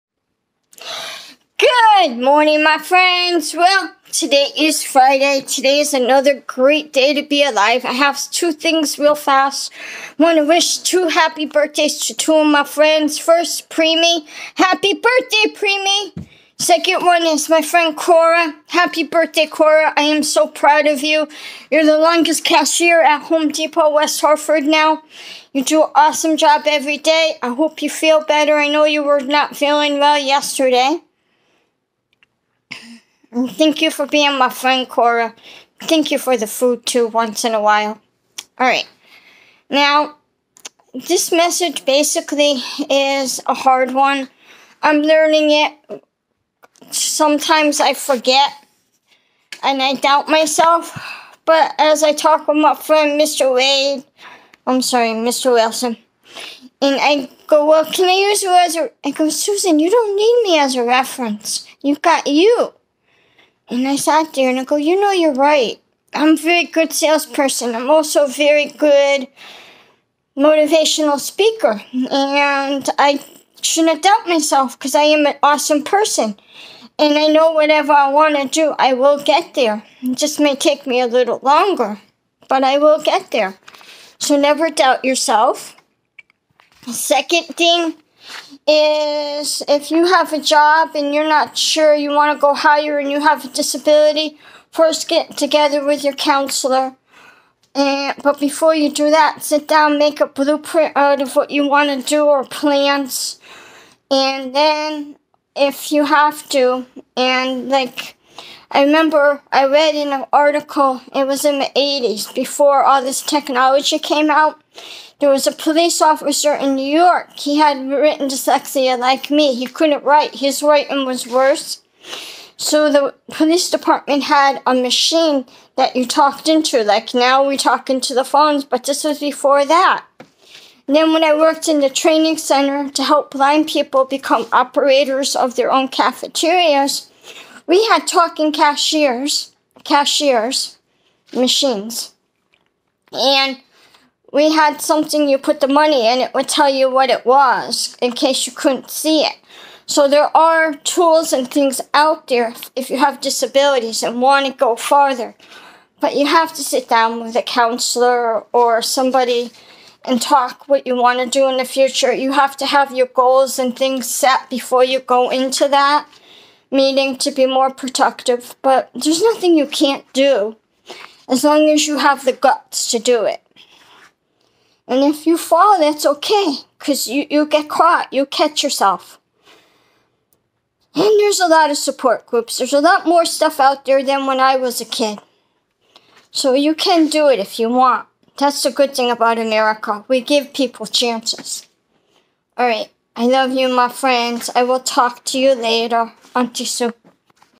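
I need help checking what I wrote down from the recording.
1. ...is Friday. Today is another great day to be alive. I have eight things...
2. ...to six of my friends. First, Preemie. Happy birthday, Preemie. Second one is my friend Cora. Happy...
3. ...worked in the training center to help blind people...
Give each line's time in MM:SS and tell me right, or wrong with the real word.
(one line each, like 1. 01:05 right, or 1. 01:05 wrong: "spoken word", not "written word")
1. 00:04 wrong: "two", not "eight"
2. 00:12 wrong: "two", not "six"
3. 02:11 right.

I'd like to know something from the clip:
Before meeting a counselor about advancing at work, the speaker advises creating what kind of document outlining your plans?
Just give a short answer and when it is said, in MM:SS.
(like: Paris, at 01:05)
blueprint, at 01:40.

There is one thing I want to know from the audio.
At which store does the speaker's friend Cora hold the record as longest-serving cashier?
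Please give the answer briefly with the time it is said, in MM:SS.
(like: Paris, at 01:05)
Home Depot West Hartford, at 00:23.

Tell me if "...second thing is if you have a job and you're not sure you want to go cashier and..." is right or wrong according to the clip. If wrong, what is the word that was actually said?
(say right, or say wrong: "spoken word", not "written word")
wrong: "higher", not "cashier".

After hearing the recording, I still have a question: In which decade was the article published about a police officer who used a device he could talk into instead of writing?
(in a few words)
80s.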